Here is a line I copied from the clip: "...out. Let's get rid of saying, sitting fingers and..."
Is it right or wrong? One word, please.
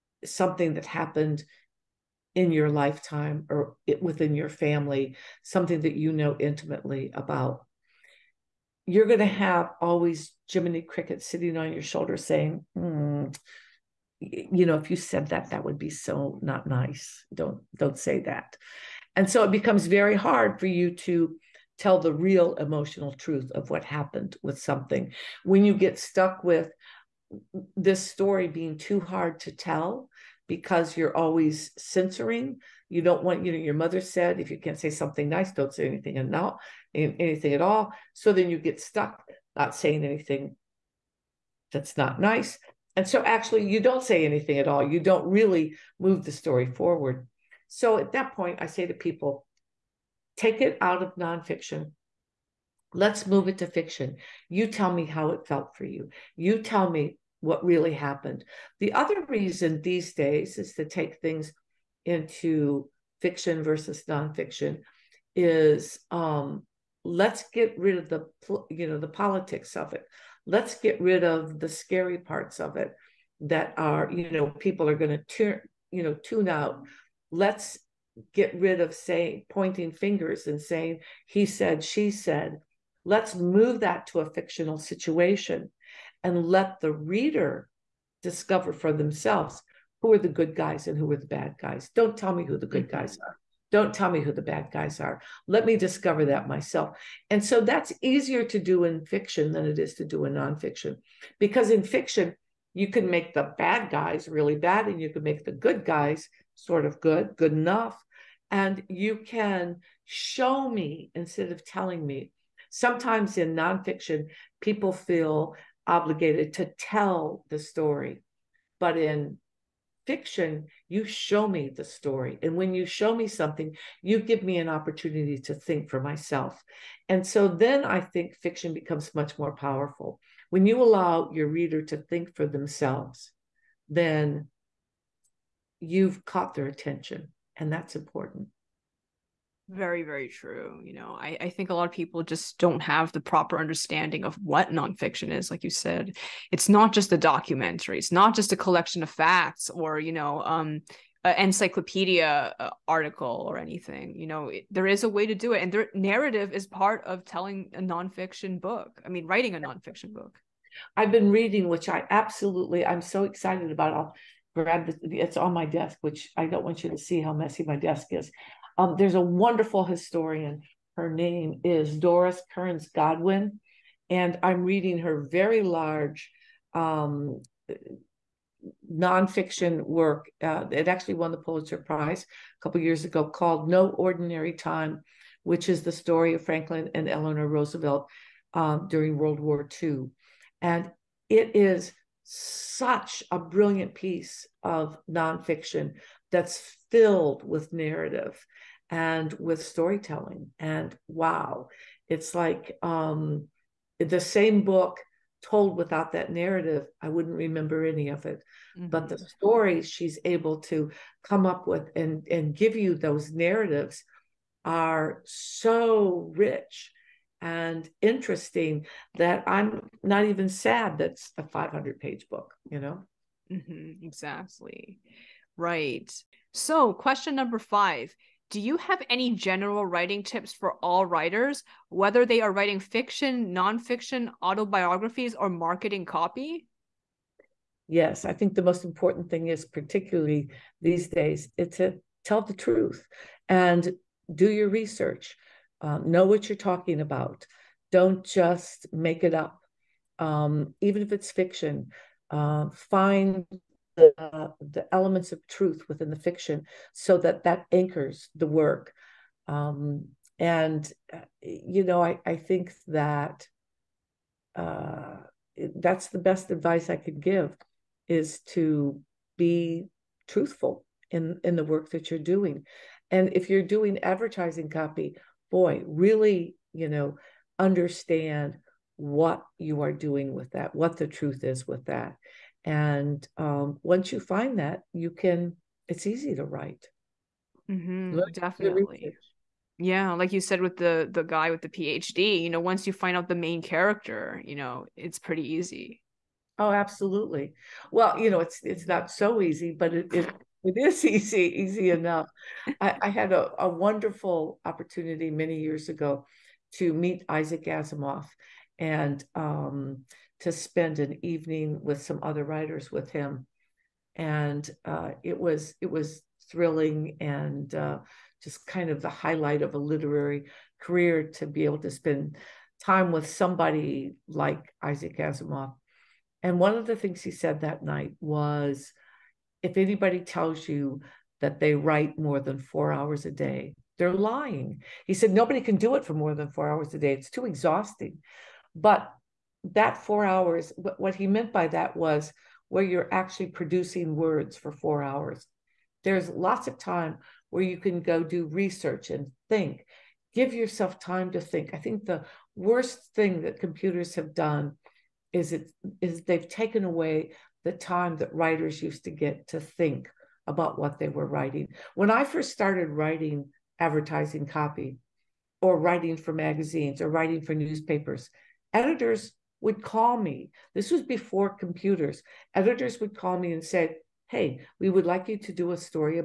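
wrong.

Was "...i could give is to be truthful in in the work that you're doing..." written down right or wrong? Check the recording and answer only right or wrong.
right.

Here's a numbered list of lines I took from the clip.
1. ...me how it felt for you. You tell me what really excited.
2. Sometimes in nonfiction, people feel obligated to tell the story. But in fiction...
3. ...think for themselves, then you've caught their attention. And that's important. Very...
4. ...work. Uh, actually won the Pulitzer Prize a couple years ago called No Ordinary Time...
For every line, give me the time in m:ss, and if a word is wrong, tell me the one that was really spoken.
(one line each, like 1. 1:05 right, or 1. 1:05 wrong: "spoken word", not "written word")
1. 0:54 wrong: "happened", not "excited"
2. 1:52 right
3. 2:11 right
4. 2:59 right.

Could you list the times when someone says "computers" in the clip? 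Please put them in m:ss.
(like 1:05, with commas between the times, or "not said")
5:53, 6:11.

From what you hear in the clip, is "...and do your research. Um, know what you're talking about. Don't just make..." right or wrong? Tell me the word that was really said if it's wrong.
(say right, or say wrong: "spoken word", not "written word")
right.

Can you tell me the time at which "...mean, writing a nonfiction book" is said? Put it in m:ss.
2:39.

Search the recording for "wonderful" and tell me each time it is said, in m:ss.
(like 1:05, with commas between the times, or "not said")
2:49, 5:03.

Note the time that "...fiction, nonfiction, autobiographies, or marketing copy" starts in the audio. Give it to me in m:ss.
3:52.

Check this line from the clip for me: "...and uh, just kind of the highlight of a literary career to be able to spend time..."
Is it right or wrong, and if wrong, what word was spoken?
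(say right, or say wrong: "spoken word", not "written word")
right.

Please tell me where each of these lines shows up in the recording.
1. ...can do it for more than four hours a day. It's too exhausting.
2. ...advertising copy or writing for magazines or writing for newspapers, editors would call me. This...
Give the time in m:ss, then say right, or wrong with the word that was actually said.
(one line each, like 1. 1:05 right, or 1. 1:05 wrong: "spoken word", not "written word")
1. 5:35 right
2. 6:03 right.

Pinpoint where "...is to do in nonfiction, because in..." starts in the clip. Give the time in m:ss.
1:39.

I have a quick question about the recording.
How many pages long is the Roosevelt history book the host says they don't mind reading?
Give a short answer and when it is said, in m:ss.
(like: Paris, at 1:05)
500, at 3:41.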